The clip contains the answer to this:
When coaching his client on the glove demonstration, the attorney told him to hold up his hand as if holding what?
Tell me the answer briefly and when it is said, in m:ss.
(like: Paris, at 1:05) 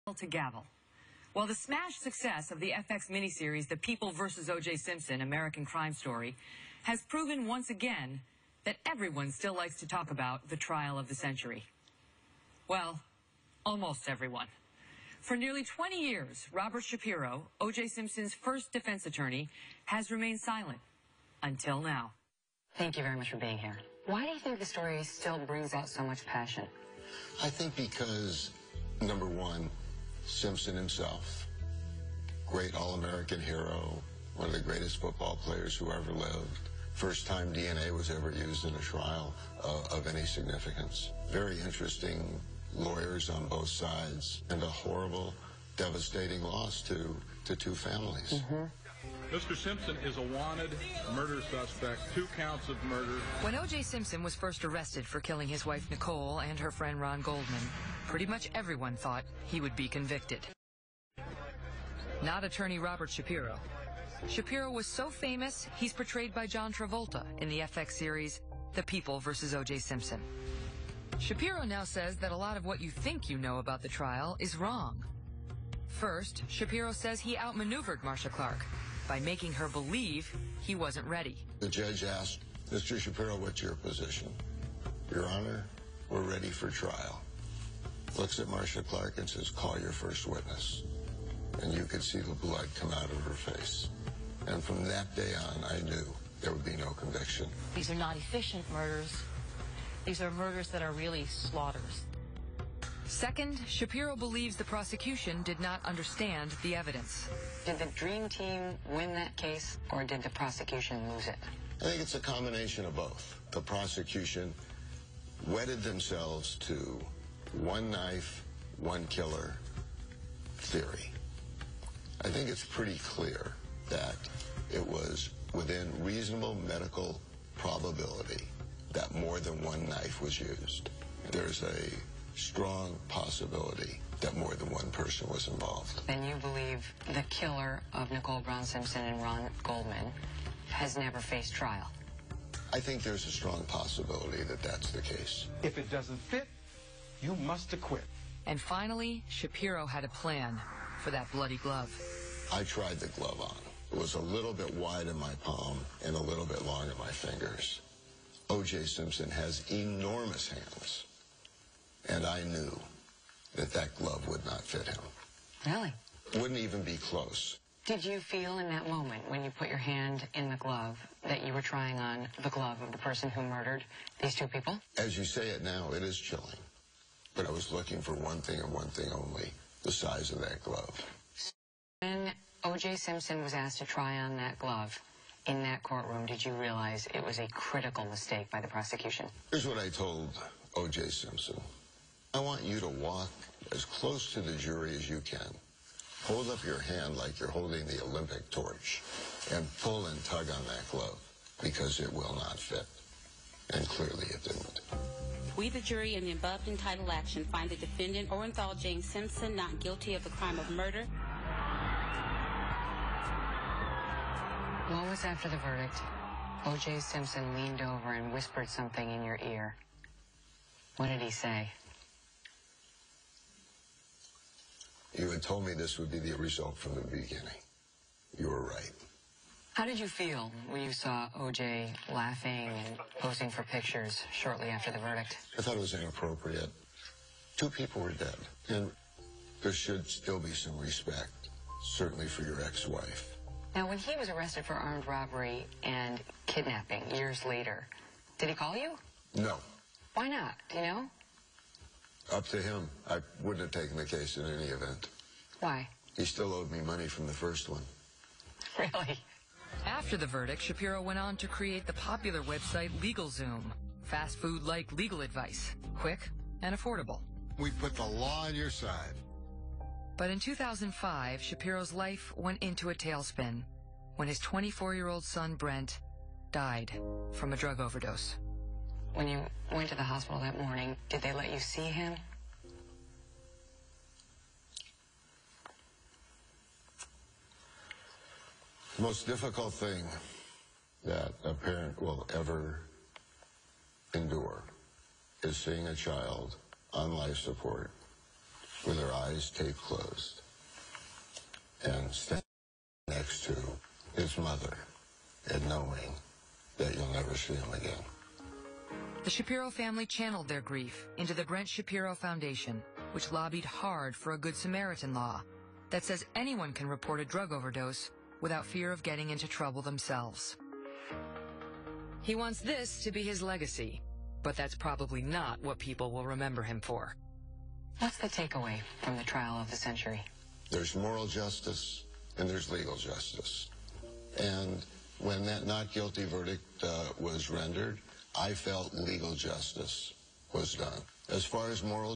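the Olympic torch, at 3:18.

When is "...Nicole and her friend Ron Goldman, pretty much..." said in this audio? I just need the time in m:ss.
0:55.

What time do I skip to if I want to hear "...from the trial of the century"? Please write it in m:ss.
5:29.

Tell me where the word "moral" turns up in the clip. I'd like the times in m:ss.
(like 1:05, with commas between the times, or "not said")
5:30, 5:41.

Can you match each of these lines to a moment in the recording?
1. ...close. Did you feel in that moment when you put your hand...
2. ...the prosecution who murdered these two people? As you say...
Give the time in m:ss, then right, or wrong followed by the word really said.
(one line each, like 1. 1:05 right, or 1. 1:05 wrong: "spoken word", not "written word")
1. 2:46 right
2. 2:52 wrong: "person", not "prosecution".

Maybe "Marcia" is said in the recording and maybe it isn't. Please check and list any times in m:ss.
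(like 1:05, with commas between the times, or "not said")
1:18, 1:28.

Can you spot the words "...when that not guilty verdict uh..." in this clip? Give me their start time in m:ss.
5:35.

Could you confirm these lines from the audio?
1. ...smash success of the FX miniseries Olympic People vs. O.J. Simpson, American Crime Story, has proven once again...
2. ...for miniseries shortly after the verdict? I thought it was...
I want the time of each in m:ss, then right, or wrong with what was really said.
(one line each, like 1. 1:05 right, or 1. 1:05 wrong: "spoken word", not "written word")
1. 0:01 wrong: "The", not "Olympic"
2. 3:53 wrong: "pictures", not "miniseries".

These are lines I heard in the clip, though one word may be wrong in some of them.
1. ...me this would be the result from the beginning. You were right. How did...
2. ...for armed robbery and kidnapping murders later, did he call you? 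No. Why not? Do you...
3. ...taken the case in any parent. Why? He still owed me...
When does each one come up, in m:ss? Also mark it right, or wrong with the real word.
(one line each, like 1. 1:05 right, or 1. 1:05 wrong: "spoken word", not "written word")
1. 3:45 right
2. 4:04 wrong: "years", not "murders"
3. 4:13 wrong: "event", not "parent".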